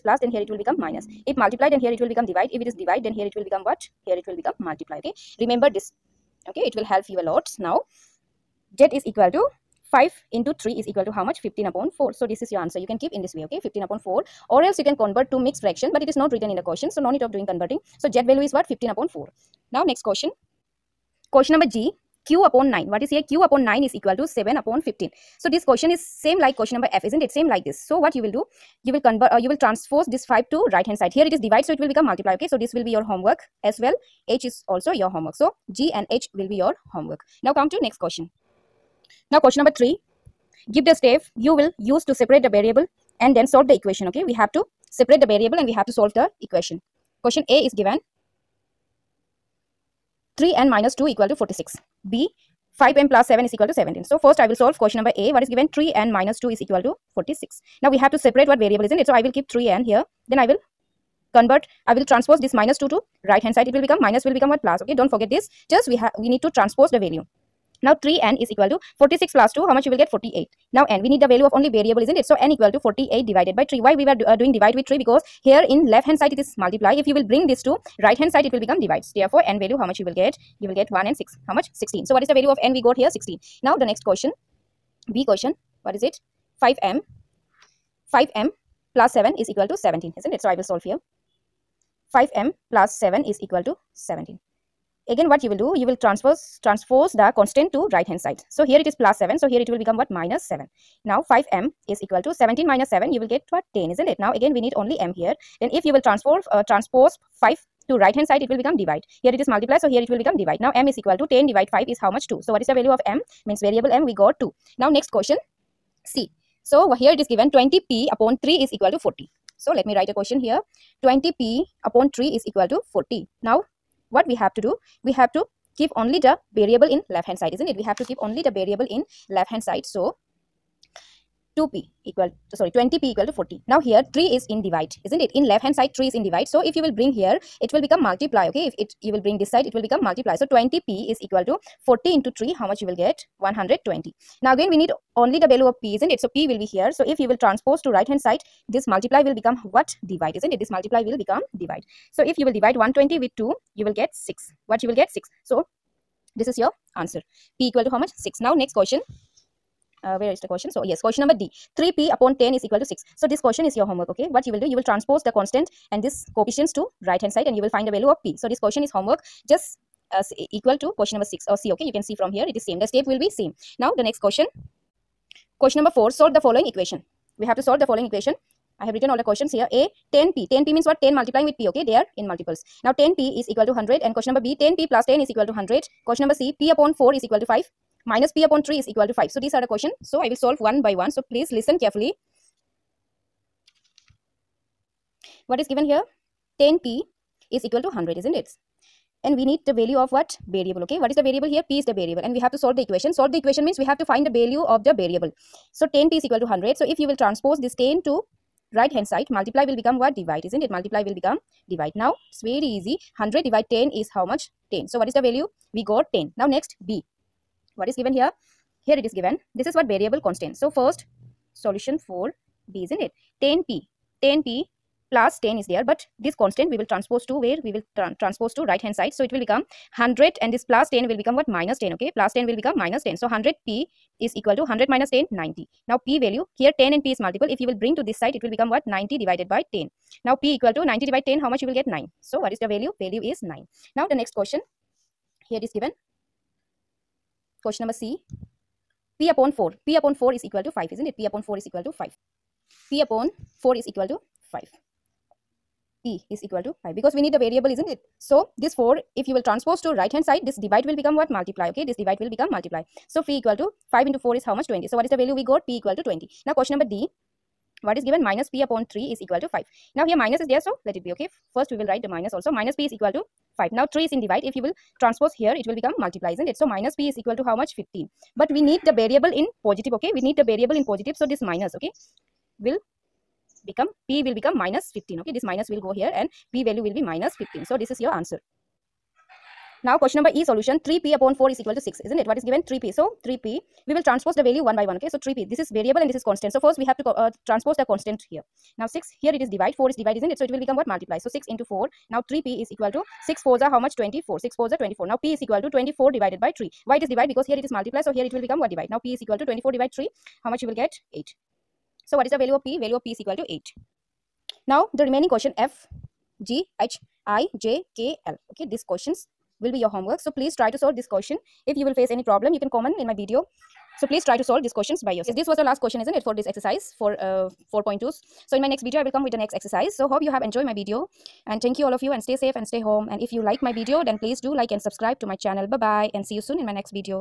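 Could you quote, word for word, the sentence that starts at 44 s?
Okay, we have to separate the variable and we have to solve the equation.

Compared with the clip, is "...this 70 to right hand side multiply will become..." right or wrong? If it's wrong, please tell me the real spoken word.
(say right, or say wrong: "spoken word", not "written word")
wrong: "10", not "70".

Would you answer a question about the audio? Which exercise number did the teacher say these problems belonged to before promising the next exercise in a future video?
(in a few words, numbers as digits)
4.2.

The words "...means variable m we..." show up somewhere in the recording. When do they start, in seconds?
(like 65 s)
113 s.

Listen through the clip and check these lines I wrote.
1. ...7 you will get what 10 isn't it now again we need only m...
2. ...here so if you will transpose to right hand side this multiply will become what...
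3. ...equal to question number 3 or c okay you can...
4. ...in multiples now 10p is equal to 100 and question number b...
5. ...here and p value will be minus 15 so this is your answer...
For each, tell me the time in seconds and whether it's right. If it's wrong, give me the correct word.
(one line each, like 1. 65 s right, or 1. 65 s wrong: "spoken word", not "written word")
1. 102 s right
2. 146 s right
3. 170 s wrong: "6", not "3"
4. 182 s right
5. 285 s right.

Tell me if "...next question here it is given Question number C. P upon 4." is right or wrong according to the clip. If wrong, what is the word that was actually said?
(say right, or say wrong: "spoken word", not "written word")
right.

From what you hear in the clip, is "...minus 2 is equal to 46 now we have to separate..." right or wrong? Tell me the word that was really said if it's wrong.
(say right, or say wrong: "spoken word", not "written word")
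right.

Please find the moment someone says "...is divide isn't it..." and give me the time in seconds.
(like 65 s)
299 s.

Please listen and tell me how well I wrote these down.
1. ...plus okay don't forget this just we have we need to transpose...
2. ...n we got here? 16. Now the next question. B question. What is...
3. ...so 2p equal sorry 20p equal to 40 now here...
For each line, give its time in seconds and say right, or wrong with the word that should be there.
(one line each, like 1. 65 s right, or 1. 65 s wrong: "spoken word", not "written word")
1. 64 s right
2. 82 s right
3. 129 s right.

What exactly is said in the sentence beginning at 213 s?
100 divided 10 is how much?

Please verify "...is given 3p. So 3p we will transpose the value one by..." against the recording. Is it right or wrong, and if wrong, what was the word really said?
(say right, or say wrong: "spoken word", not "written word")
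right.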